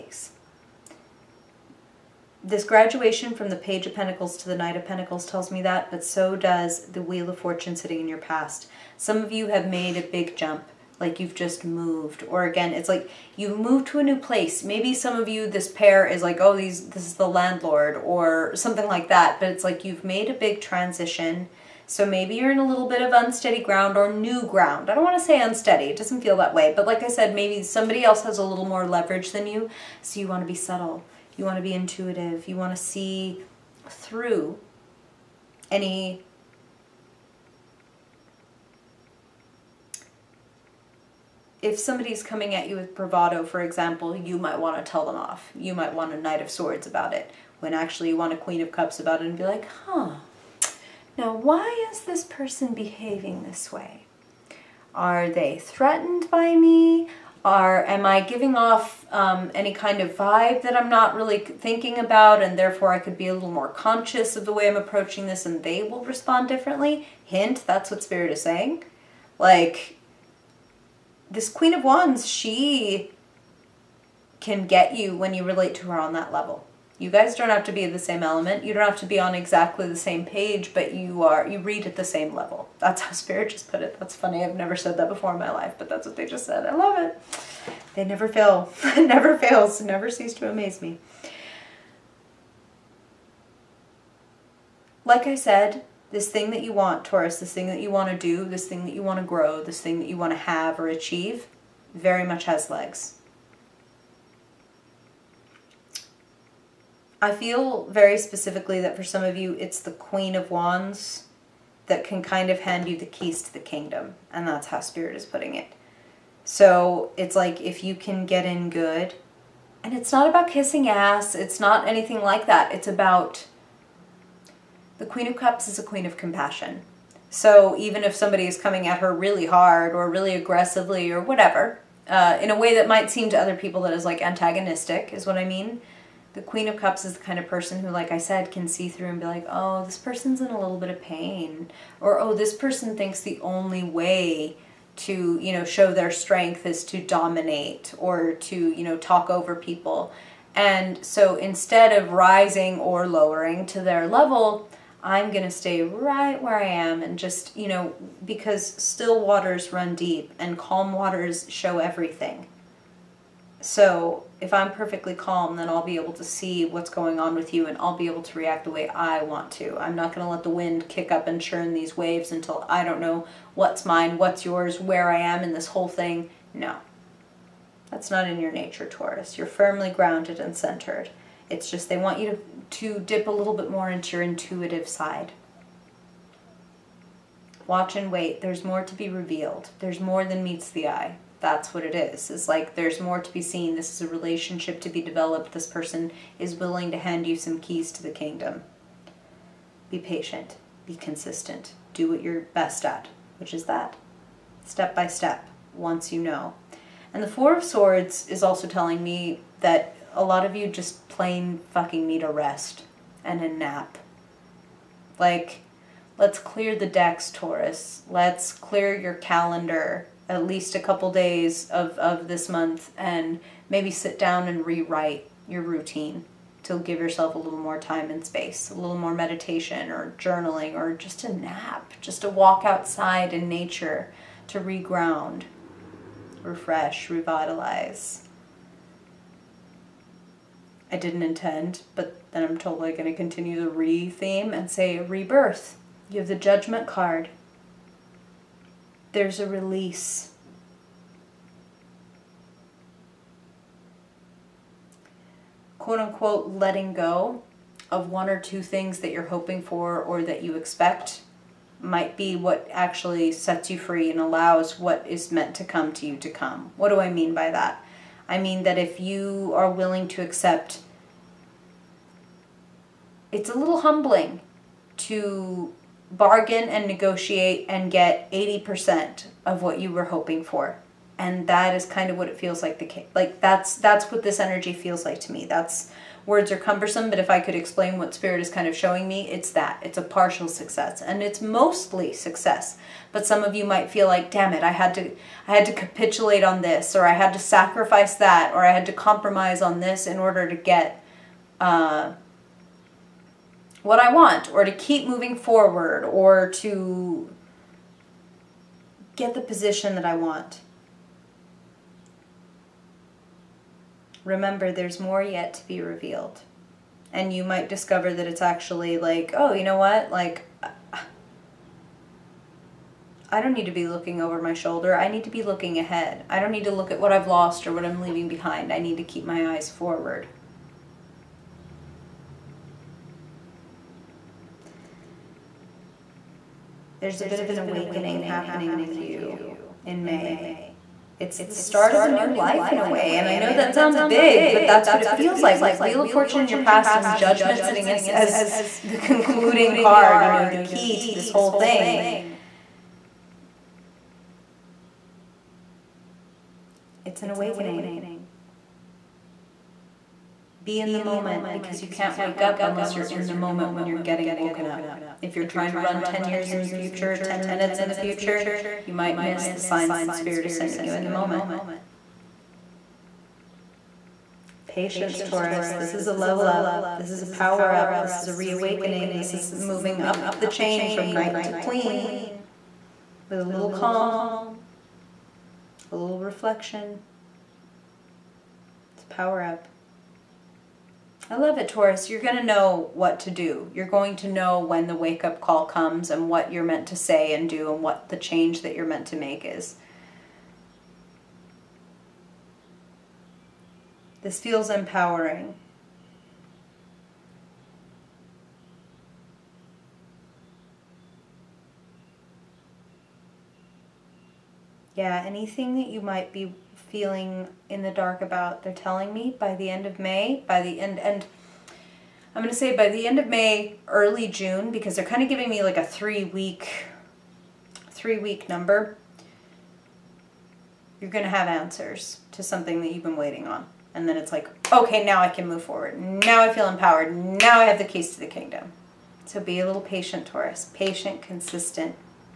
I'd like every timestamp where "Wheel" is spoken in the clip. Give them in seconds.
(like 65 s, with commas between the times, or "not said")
7 s, 345 s.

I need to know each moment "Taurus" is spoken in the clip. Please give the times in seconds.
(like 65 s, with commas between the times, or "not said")
97 s, 178 s, 217 s, 375 s, 391 s, 440 s.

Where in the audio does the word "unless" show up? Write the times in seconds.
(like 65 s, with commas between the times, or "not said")
362 s.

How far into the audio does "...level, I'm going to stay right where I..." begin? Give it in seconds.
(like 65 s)
154 s.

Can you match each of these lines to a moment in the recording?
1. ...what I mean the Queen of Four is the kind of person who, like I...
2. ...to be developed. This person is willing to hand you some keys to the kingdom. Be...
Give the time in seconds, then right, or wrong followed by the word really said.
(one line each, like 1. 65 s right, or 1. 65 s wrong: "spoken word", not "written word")
1. 135 s wrong: "Cups", not "Four"
2. 194 s right.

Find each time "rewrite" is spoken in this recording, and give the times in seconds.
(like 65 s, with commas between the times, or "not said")
224 s.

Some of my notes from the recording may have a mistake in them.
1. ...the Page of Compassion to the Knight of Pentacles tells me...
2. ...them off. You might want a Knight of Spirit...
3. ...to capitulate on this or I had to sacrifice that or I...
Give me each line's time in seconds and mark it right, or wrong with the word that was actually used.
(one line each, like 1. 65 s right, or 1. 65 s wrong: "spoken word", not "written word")
1. 3 s wrong: "Pentacles", not "Compassion"
2. 45 s wrong: "Swords", not "Spirit"
3. 295 s right.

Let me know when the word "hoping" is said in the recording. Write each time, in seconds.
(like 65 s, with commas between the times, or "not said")
259 s, 280 s.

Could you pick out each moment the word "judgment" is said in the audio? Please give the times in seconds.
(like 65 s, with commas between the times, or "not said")
246 s, 347 s.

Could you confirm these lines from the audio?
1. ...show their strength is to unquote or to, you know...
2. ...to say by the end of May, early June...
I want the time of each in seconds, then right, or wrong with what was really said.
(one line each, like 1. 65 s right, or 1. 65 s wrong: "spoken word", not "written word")
1. 145 s wrong: "dominate", not "unquote"
2. 422 s right.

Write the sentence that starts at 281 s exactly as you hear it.
And that is kind of what it feels like the like that's that's what this energy feels like to me.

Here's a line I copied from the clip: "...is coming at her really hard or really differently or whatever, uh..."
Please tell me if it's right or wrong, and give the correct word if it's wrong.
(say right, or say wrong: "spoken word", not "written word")
wrong: "aggressively", not "differently".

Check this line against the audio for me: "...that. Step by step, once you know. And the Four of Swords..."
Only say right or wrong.
right.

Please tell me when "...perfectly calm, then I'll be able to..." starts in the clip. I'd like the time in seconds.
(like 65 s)
164 s.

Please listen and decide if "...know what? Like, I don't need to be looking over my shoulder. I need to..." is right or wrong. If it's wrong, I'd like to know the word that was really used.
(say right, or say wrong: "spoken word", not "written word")
right.